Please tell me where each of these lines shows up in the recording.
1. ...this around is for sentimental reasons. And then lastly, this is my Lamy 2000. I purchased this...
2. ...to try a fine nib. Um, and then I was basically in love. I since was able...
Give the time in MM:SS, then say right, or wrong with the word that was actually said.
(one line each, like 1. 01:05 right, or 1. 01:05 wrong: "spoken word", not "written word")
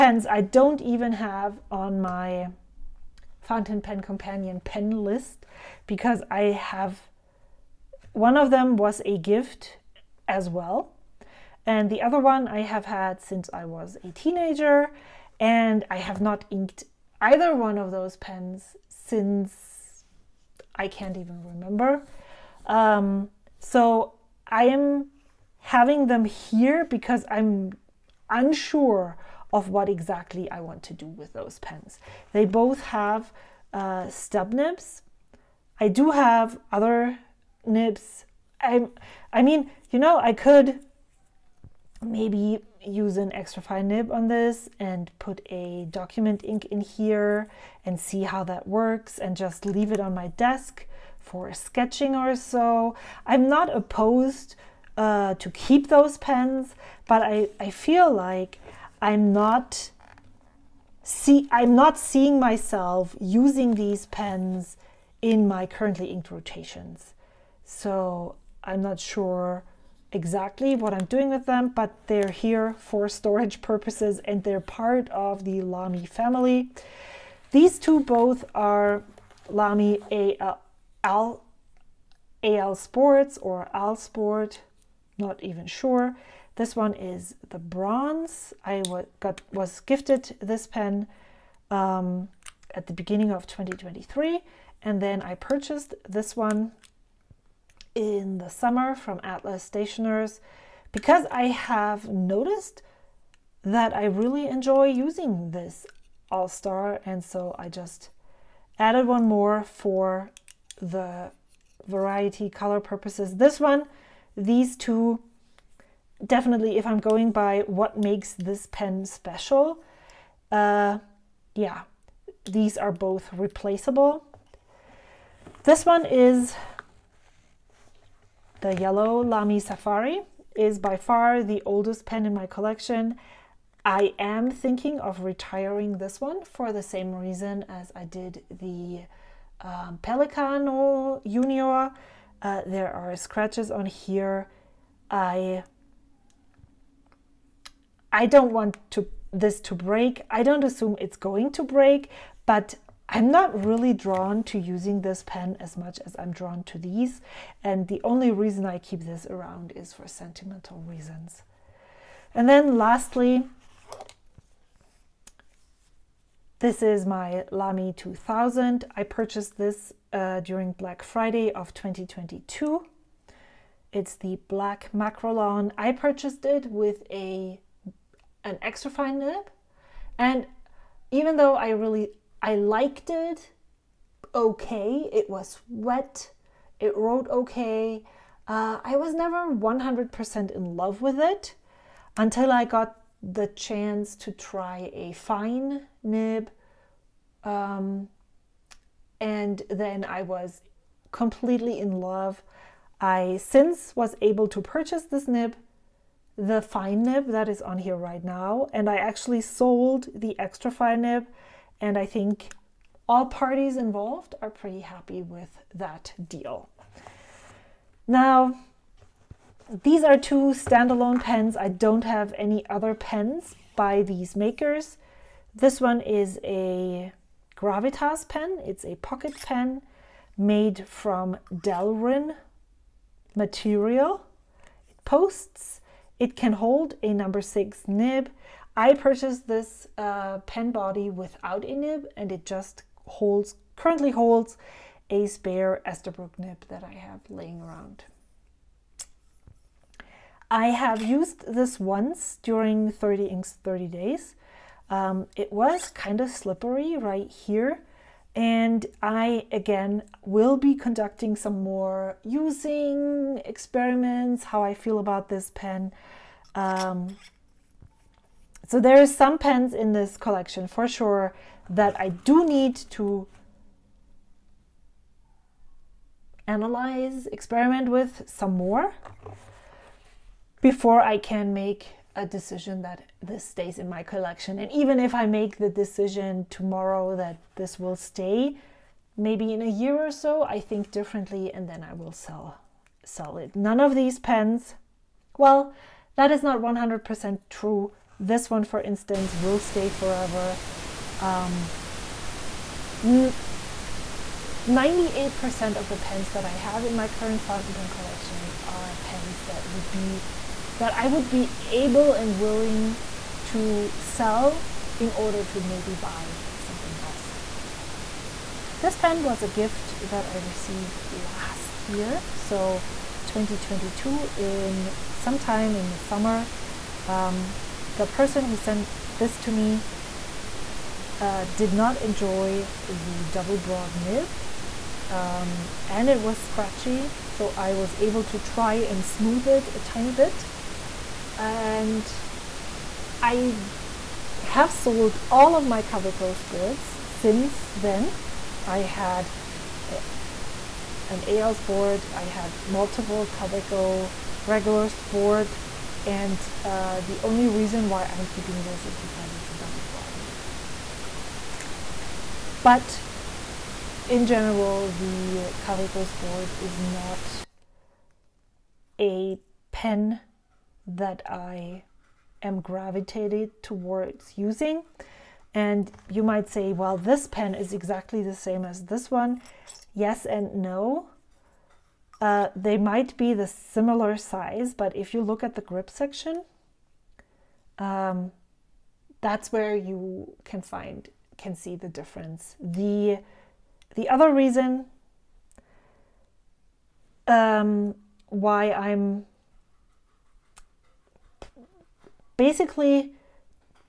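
1. 02:38 right
2. 03:14 wrong: "completely", not "basically".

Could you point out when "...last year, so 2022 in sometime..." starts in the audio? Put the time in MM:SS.
05:21.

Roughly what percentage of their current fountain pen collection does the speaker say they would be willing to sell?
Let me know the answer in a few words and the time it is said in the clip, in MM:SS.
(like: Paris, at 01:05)
98%, at 05:01.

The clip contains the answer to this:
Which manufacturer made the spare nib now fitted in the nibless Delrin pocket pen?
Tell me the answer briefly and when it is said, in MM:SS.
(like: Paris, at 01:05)
Esterbrook, at 04:05.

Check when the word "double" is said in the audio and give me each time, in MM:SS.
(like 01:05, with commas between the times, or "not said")
05:33, 05:59.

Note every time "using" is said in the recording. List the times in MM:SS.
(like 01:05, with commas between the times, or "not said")
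01:03, 01:44, 02:34, 04:22, 06:14.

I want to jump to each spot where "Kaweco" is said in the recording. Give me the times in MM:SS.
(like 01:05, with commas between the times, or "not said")
05:45, 05:53, 06:05.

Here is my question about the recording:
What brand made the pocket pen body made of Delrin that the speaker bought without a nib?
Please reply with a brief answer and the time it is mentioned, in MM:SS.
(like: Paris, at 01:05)
Gravitas, at 03:47.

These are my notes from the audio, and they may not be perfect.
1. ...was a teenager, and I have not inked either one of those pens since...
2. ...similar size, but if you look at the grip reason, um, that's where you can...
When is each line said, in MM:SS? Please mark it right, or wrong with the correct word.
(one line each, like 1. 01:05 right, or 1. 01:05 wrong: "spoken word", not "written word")
1. 00:13 right
2. 06:23 wrong: "section", not "reason".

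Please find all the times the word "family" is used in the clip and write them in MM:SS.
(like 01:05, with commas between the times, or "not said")
01:16.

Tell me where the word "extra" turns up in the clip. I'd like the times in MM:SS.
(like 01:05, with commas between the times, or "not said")
00:43, 02:58, 03:30.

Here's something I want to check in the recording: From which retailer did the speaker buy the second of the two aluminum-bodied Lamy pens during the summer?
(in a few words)
Atlas Stationers.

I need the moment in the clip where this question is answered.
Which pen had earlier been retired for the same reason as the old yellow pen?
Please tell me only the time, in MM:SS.
02:20.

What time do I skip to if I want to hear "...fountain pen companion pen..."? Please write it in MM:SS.
00:03.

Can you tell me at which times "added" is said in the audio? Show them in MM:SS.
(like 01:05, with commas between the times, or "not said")
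01:48.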